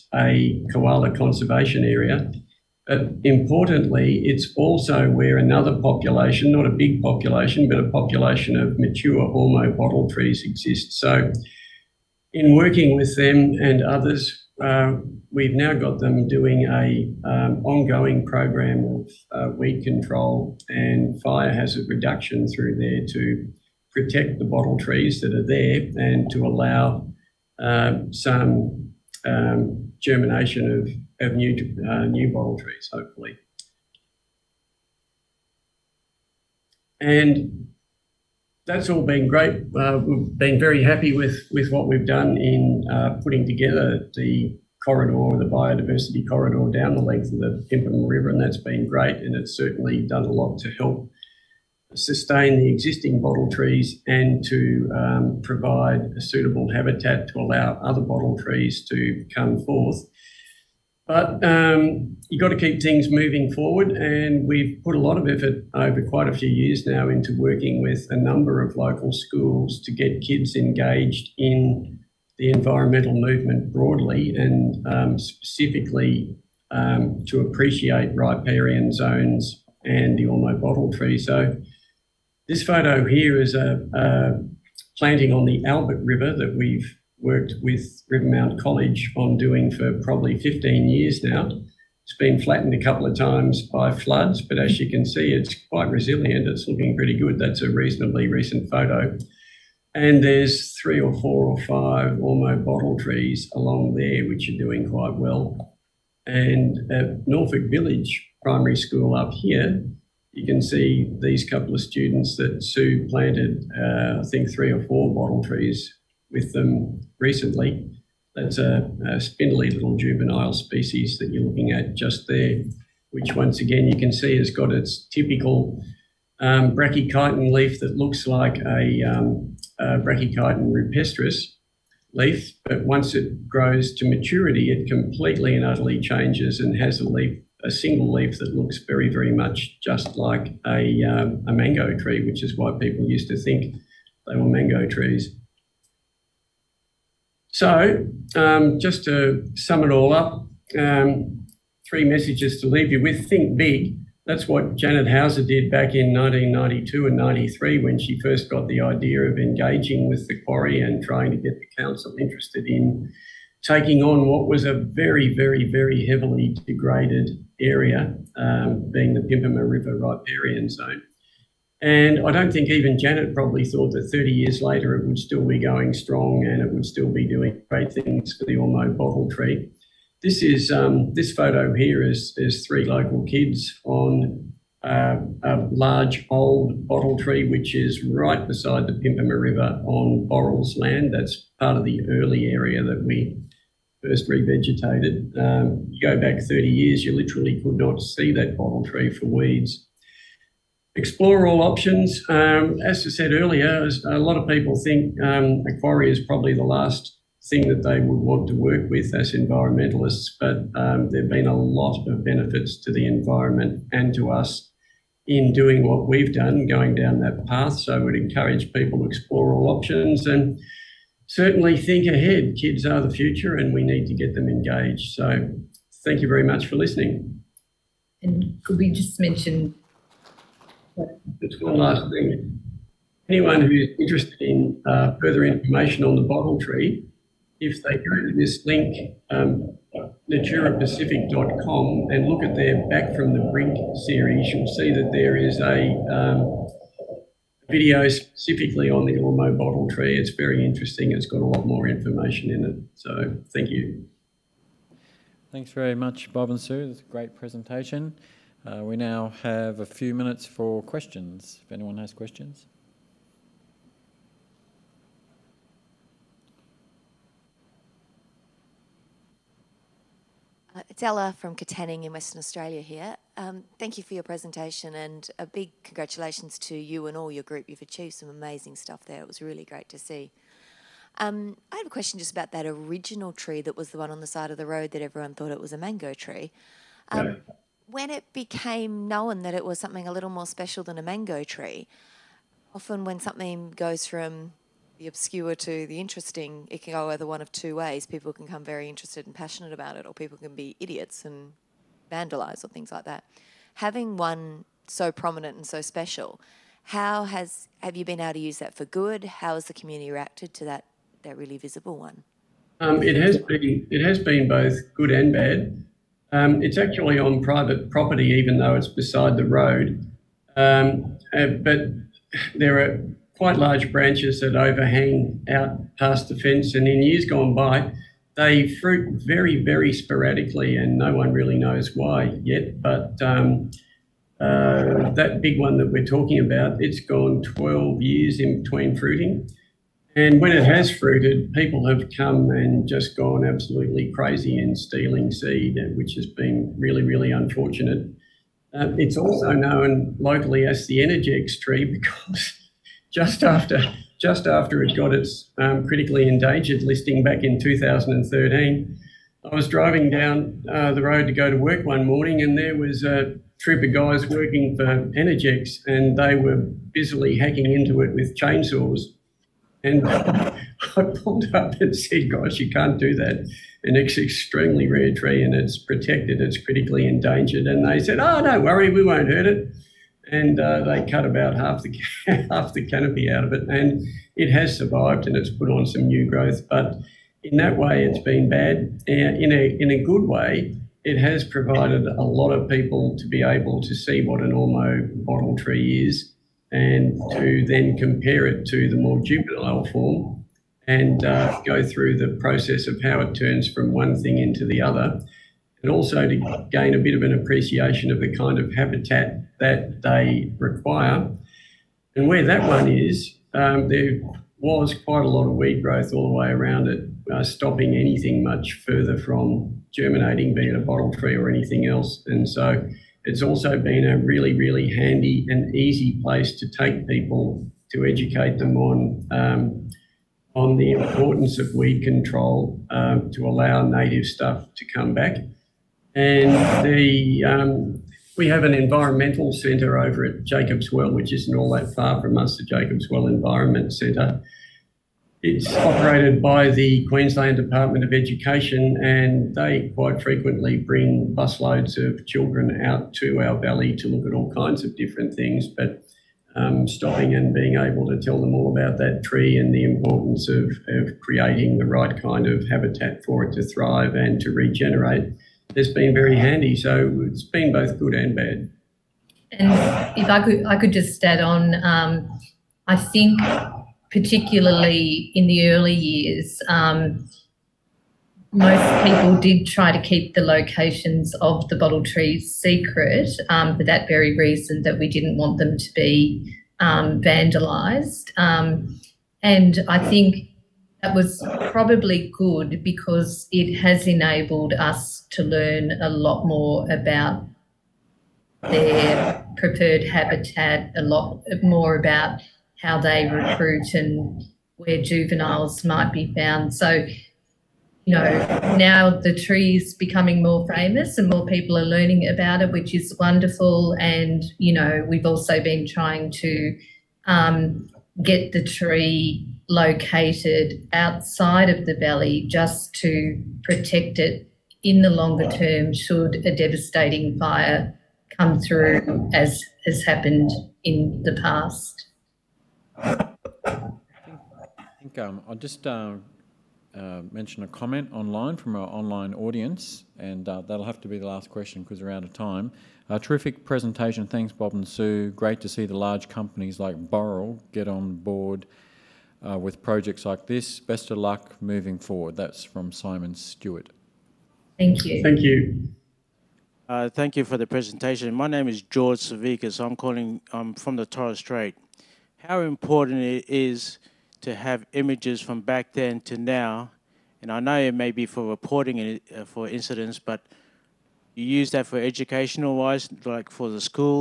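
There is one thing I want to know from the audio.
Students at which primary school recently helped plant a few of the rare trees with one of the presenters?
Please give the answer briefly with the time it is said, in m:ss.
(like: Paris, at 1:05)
Norfolk Village Primary School, at 1:47.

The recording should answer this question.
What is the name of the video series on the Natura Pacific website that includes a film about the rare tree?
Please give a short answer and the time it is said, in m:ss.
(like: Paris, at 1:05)
Back from the Brink, at 4:02.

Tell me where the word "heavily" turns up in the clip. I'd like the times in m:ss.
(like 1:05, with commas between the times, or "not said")
2:46.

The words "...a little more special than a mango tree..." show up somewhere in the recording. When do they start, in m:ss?
4:50.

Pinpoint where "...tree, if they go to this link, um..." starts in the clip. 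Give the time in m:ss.
3:56.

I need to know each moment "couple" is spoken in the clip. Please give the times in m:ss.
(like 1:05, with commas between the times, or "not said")
1:32, 1:51.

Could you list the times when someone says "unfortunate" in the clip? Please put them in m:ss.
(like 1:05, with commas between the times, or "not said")
5:47.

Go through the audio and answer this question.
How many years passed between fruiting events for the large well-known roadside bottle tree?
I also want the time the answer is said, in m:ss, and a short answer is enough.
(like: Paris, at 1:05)
12, at 5:37.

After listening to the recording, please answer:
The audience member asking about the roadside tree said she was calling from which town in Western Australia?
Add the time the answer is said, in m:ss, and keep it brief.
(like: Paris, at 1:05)
Katanning, at 4:31.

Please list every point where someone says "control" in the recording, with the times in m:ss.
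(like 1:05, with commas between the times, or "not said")
0:19, 7:12.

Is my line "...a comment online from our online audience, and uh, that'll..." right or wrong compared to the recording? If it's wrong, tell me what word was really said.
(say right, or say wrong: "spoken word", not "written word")
right.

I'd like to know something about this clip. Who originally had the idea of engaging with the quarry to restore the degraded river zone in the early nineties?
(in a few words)
Janet Hauser.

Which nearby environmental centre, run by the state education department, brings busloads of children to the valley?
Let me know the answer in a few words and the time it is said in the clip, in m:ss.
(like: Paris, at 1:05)
Jacobs Well Environment Centre, at 7:22.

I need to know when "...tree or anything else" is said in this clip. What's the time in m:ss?
7:01.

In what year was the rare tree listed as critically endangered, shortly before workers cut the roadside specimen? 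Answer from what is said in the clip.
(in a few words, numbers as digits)
2013.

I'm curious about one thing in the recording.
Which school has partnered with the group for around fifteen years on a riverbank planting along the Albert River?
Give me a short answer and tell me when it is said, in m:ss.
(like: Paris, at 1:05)
Rivermount College, at 1:28.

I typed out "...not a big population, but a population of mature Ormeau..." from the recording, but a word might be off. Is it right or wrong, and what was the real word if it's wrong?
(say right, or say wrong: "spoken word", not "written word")
right.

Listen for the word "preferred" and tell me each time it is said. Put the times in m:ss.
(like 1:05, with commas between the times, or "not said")
8:19.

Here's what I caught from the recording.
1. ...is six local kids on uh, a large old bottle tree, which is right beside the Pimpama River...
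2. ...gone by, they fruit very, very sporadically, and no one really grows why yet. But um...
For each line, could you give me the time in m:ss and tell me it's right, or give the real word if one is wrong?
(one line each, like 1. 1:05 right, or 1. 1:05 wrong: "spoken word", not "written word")
1. 3:02 wrong: "three", not "six"
2. 5:27 wrong: "knows", not "grows".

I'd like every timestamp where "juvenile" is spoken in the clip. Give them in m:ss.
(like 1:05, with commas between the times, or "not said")
1:59, 6:39, 8:25.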